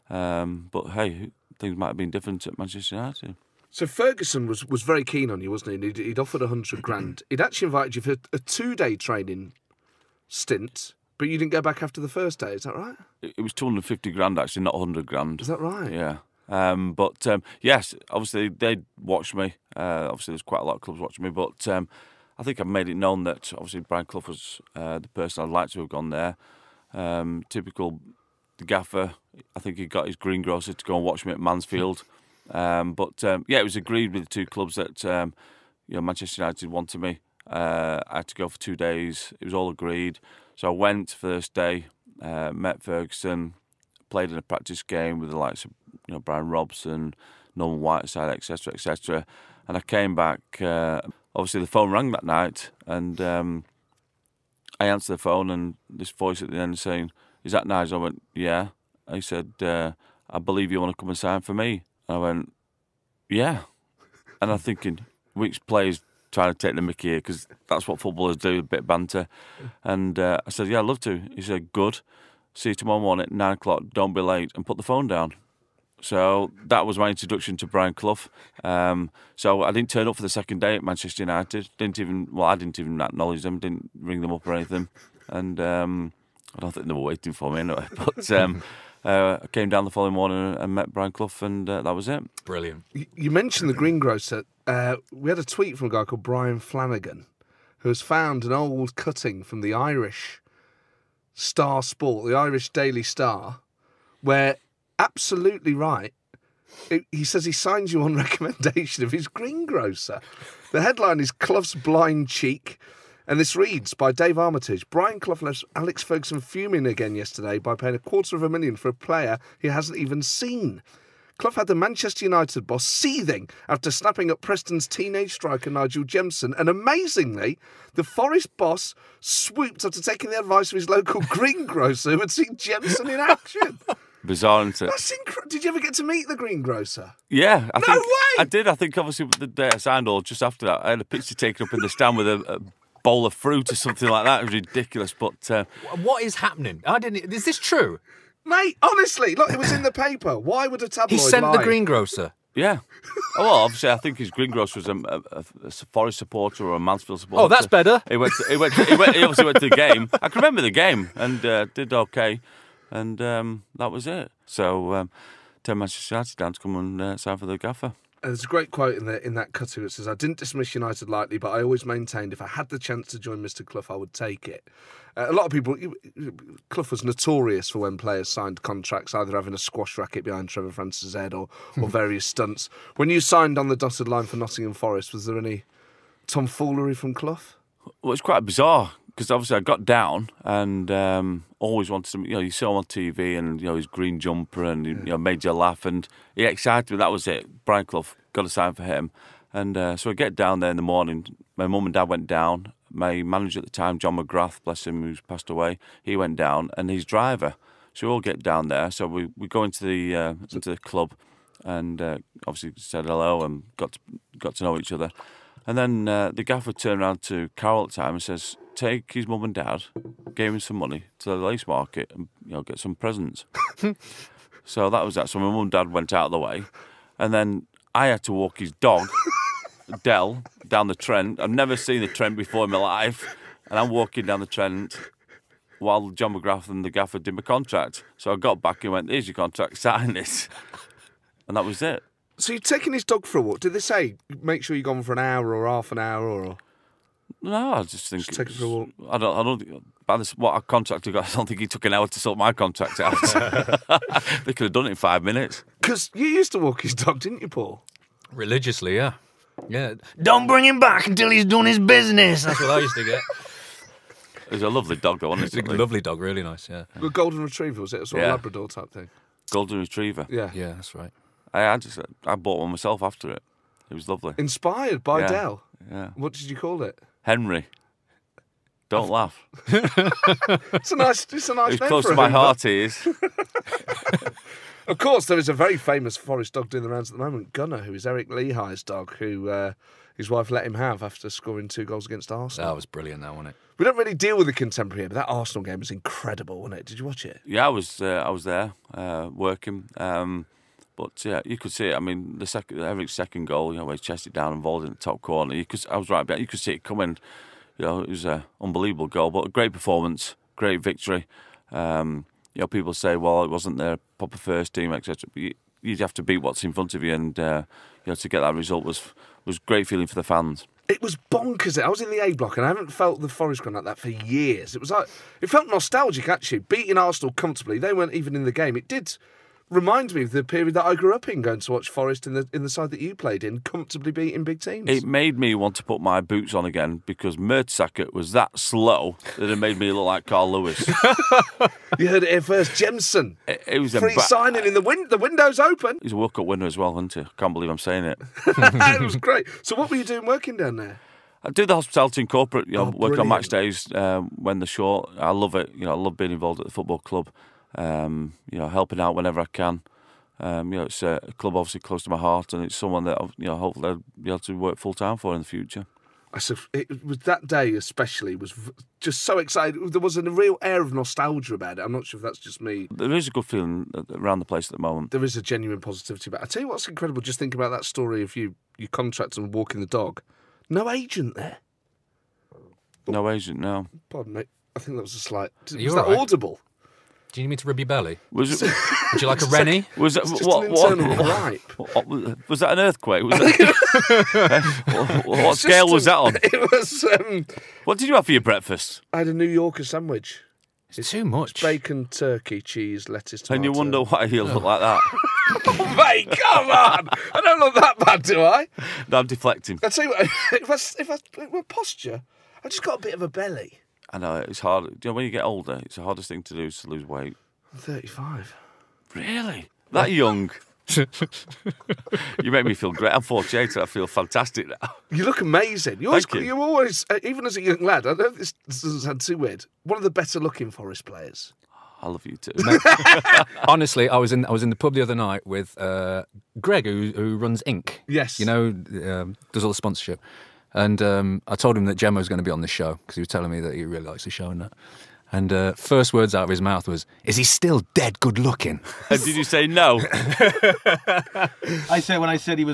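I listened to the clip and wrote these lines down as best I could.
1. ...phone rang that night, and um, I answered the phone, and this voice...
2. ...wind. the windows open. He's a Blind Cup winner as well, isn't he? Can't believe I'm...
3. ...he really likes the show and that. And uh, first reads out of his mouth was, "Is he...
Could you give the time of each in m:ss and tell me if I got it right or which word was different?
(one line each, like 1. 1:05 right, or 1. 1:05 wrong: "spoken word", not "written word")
1. 0:51 right
2. 5:44 wrong: "World", not "Blind"
3. 7:23 wrong: "words", not "reads".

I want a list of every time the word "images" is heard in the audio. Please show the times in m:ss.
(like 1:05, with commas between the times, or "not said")
not said.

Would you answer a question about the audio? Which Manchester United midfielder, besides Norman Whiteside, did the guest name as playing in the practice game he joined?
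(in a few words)
Brian Robson.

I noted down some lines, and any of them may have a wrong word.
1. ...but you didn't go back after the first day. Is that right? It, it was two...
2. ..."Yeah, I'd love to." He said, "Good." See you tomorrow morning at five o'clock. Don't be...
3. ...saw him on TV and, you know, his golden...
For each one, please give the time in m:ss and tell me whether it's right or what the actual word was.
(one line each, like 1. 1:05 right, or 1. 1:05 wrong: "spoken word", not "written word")
1. 0:11 right
2. 1:10 wrong: "nine", not "five"
3. 3:12 wrong: "green", not "golden".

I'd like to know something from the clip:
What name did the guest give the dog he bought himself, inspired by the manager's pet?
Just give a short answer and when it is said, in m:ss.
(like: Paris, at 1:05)
Henry, at 4:37.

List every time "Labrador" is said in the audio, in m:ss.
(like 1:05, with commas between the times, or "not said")
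4:28.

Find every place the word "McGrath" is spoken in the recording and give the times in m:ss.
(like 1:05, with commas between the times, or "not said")
3:24, 3:56.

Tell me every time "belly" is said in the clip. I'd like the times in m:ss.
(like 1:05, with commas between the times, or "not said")
6:27, 6:53.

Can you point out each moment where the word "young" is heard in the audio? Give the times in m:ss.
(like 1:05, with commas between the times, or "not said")
7:00, 7:07.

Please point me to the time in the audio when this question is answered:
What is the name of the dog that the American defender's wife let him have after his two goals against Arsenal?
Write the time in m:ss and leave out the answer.
4:47.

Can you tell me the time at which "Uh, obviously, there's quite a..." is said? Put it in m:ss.
0:19.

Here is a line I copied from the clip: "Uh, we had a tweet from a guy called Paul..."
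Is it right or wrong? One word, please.
wrong.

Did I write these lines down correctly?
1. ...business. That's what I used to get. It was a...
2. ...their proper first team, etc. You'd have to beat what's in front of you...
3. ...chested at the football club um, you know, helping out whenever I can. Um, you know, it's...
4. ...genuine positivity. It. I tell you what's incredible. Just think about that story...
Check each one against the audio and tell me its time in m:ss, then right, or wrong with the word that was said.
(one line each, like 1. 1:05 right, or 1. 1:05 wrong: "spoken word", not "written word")
1. 4:21 right
2. 5:13 right
3. 5:56 wrong: "involved", not "chested"
4. 6:15 right.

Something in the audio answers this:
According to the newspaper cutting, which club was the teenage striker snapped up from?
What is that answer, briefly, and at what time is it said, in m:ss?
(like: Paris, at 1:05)
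Preston, at 2:04.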